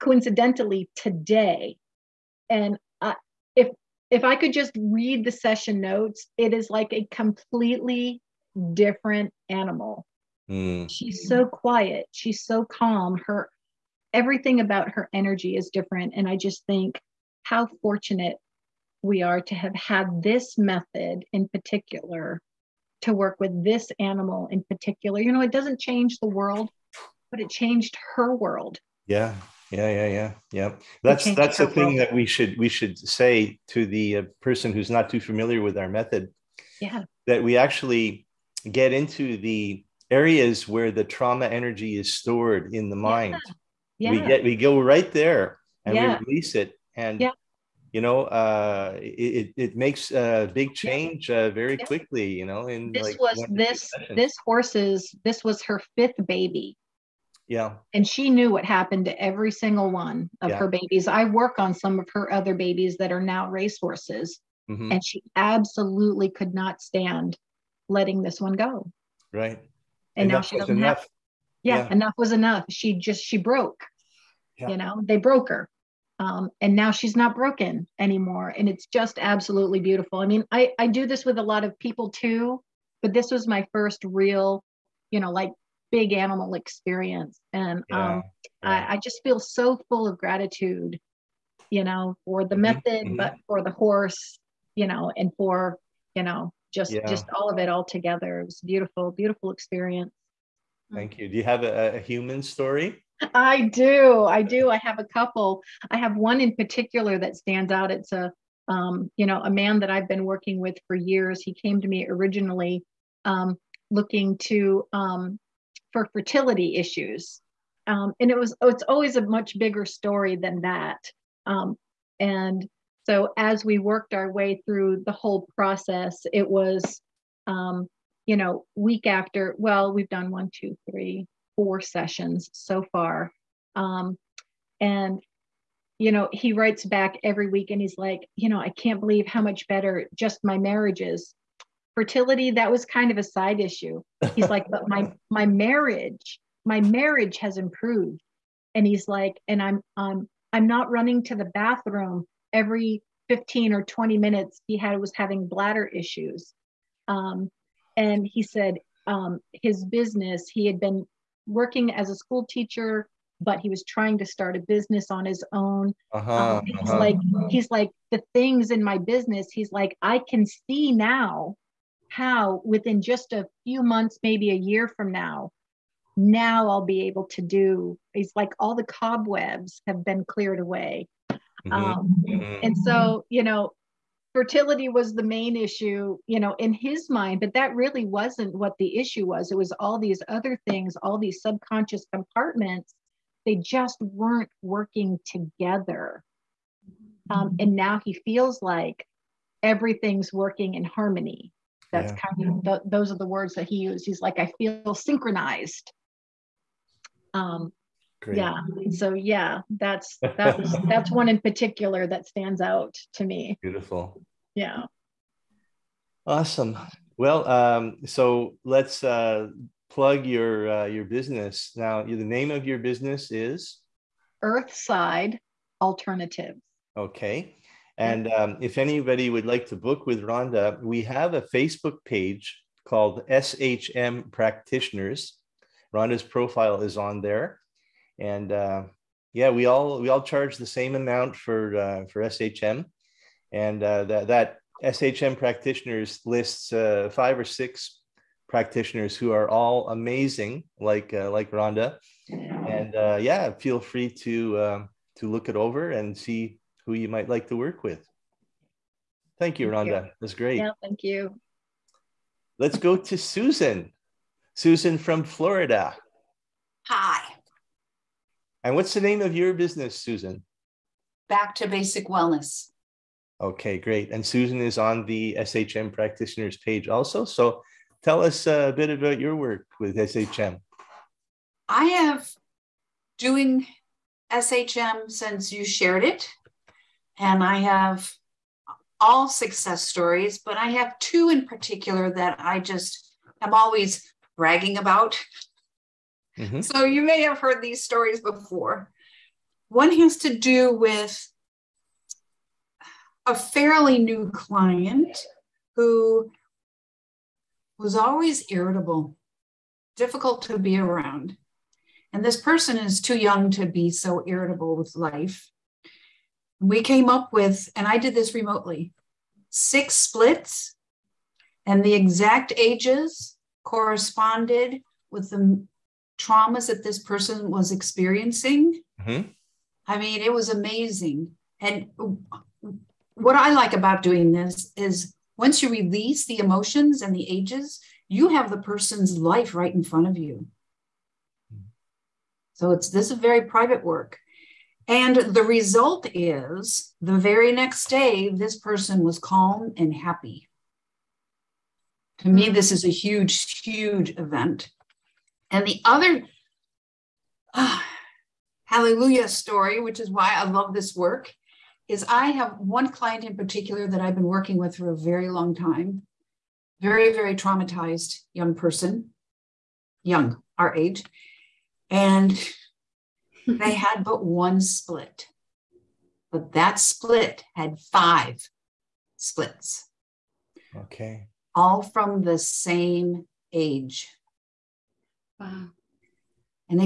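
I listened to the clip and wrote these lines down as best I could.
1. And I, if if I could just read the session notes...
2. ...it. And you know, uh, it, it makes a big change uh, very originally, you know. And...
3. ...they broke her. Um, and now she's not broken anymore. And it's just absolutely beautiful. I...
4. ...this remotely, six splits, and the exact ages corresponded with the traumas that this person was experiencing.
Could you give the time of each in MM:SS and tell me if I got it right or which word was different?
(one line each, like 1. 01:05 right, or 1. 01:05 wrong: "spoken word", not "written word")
1. 00:02 right
2. 00:46 wrong: "quickly", not "originally"
3. 01:15 right
4. 05:18 right.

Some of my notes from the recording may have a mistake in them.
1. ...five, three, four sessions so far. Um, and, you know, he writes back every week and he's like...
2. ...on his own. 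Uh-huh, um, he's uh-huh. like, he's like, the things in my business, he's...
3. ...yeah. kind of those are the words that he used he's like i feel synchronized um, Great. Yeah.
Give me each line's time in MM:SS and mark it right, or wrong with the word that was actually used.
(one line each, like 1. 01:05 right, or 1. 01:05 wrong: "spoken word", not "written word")
1. 02:10 wrong: "two", not "five"
2. 02:45 right
3. 03:22 right.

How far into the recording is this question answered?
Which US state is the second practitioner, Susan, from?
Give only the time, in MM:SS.
04:25.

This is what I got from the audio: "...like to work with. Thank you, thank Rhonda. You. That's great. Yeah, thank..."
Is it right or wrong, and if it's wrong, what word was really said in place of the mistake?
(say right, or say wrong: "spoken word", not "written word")
right.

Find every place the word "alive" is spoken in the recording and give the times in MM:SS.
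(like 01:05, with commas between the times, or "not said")
not said.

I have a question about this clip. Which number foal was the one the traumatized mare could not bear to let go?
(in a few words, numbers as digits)
5th.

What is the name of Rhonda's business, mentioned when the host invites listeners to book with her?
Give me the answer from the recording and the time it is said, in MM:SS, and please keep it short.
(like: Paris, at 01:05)
Earthside Alternative, at 03:44.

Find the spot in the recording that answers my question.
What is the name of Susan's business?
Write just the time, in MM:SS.
04:31.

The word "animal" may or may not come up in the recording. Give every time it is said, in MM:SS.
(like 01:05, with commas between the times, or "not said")
00:09, 00:23, 01:26.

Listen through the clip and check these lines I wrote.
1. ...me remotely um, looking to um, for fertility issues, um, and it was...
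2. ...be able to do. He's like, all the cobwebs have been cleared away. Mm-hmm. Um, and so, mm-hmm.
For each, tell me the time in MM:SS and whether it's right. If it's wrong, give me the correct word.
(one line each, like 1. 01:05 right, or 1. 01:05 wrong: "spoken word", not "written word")
1. 01:51 wrong: "originally", not "remotely"
2. 02:56 right.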